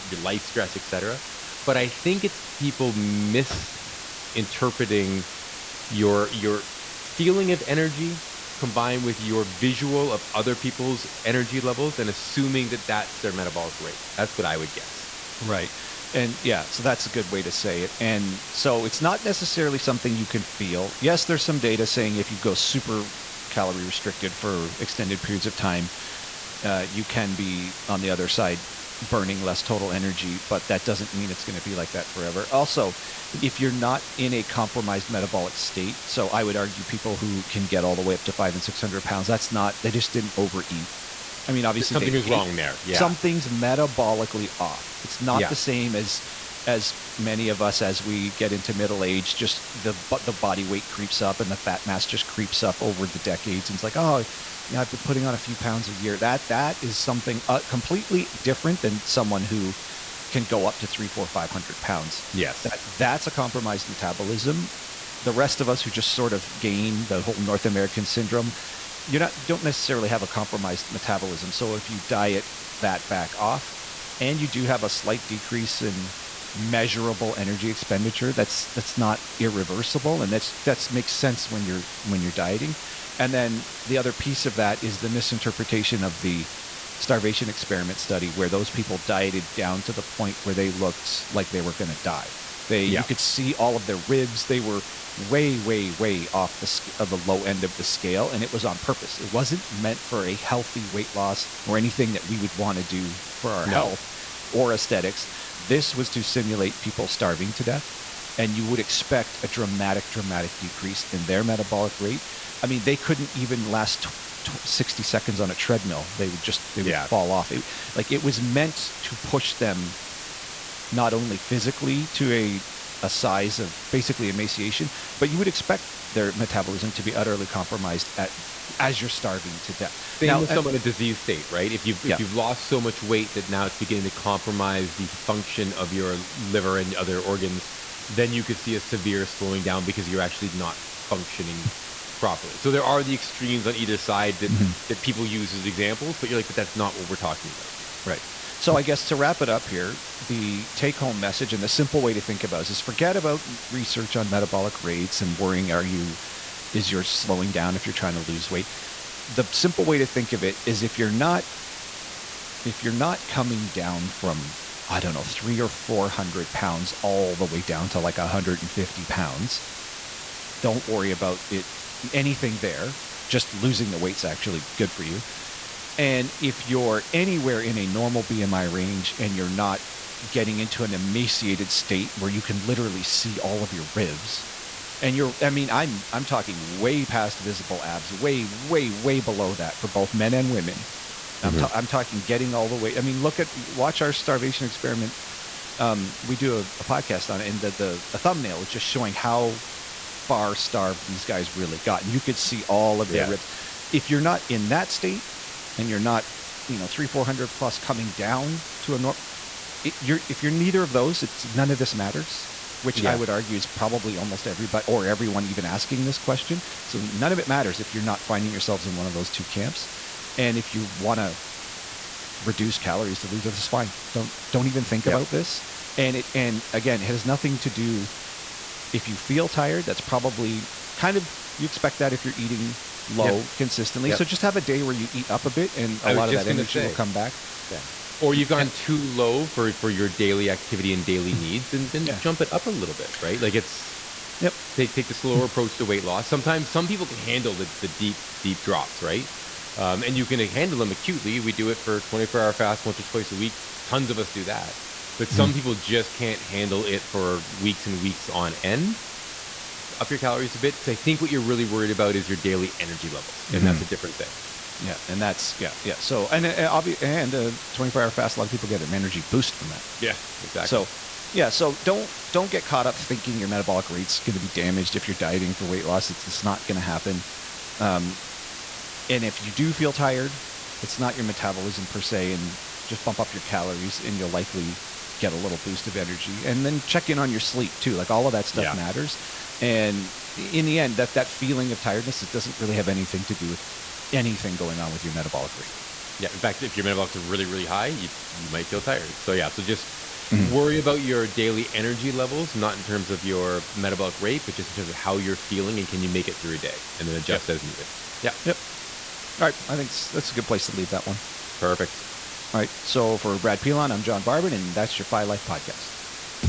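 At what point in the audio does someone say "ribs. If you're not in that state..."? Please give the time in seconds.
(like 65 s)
203 s.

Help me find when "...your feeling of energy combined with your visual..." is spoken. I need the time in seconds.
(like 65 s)
6 s.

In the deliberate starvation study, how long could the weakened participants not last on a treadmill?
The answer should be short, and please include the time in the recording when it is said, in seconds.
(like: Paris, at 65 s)
60 seconds, at 114 s.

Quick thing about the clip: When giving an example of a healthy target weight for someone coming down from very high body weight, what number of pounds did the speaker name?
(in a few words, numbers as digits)
150 pounds.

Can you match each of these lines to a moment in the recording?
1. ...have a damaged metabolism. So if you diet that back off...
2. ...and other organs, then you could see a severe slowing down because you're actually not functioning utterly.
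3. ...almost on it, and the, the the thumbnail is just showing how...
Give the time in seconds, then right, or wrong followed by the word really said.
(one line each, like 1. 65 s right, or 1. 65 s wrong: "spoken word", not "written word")
1. 70 s wrong: "compromised", not "damaged"
2. 136 s wrong: "properly", not "utterly"
3. 196 s wrong: "podcast", not "almost".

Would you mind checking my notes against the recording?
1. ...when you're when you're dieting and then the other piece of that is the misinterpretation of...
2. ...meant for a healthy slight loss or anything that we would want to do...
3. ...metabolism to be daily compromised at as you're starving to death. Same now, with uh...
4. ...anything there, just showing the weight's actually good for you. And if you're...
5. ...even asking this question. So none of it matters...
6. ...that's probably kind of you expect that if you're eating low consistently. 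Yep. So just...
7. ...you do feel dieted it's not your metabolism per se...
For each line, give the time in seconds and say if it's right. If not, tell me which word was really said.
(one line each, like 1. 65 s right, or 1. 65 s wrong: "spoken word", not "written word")
1. 81 s right
2. 99 s wrong: "weight", not "slight"
3. 126 s wrong: "utterly", not "daily"
4. 172 s wrong: "losing", not "showing"
5. 215 s right
6. 229 s right
7. 279 s wrong: "tired", not "dieted".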